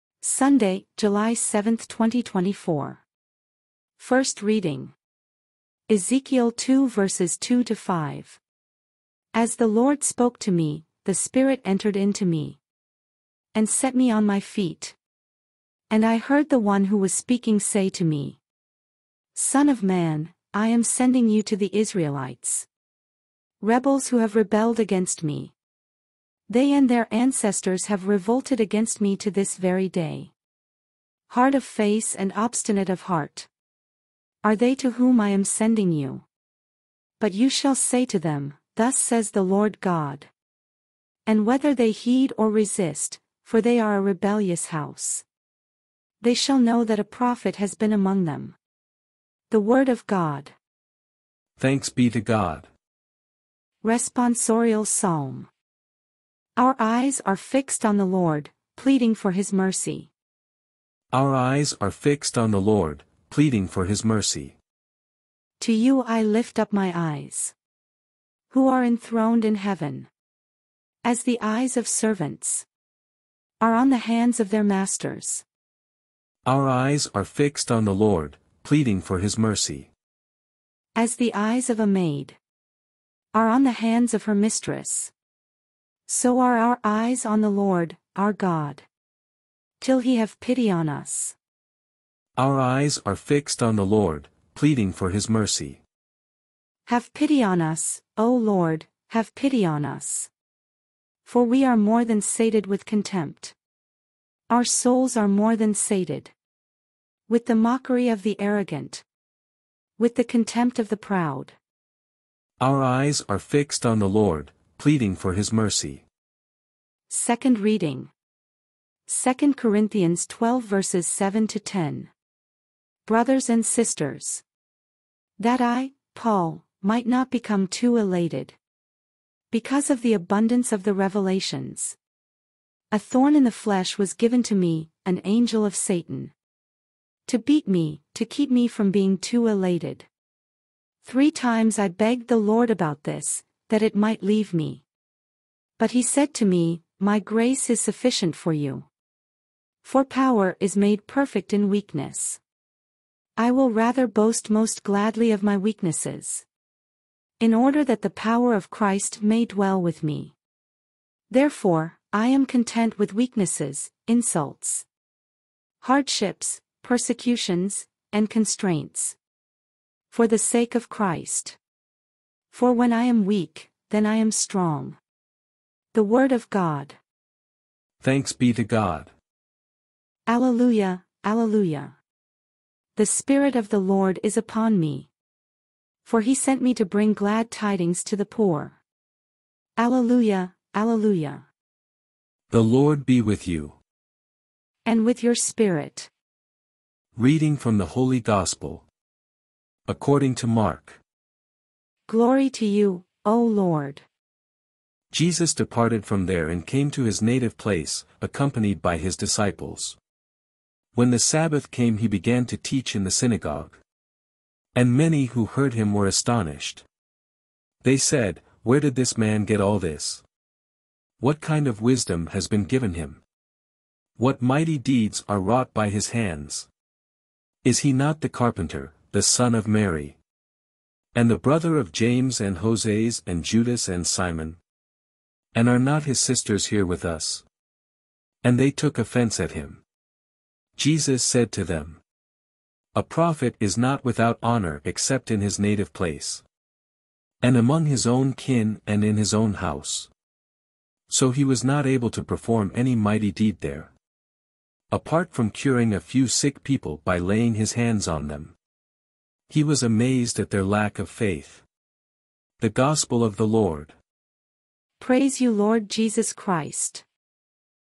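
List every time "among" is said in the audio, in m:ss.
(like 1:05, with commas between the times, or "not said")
0:47, 4:07.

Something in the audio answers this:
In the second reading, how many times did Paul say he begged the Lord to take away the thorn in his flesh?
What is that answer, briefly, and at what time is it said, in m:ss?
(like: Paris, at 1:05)
3, at 2:21.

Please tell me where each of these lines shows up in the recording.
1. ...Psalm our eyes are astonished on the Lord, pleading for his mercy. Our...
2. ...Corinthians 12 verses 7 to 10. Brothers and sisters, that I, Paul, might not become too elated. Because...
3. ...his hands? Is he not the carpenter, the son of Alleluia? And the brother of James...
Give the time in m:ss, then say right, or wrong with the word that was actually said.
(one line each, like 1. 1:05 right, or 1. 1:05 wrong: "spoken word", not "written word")
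1. 0:54 wrong: "fixed", not "astonished"
2. 1:59 right
3. 3:45 wrong: "Mary", not "Alleluia".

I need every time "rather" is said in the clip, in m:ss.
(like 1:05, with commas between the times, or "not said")
2:33.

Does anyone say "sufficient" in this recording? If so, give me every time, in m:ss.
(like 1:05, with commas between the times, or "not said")
2:27.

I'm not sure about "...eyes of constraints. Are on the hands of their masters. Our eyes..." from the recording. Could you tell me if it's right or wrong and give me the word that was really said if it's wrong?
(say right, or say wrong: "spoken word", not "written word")
wrong: "servants", not "constraints".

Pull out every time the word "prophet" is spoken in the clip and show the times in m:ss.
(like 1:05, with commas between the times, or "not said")
0:47, 4:03.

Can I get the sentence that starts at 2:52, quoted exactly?
For when I am weak, then I am strong.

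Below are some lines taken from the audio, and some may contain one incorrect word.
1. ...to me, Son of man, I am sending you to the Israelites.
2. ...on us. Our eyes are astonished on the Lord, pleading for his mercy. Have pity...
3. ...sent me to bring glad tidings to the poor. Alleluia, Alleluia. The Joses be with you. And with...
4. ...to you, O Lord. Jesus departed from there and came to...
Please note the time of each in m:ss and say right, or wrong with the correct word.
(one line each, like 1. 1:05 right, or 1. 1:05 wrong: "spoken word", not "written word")
1. 0:17 right
2. 1:30 wrong: "fixed", not "astonished"
3. 3:06 wrong: "Lord", not "Joses"
4. 3:22 right.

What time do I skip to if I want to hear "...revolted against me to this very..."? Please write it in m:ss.
0:28.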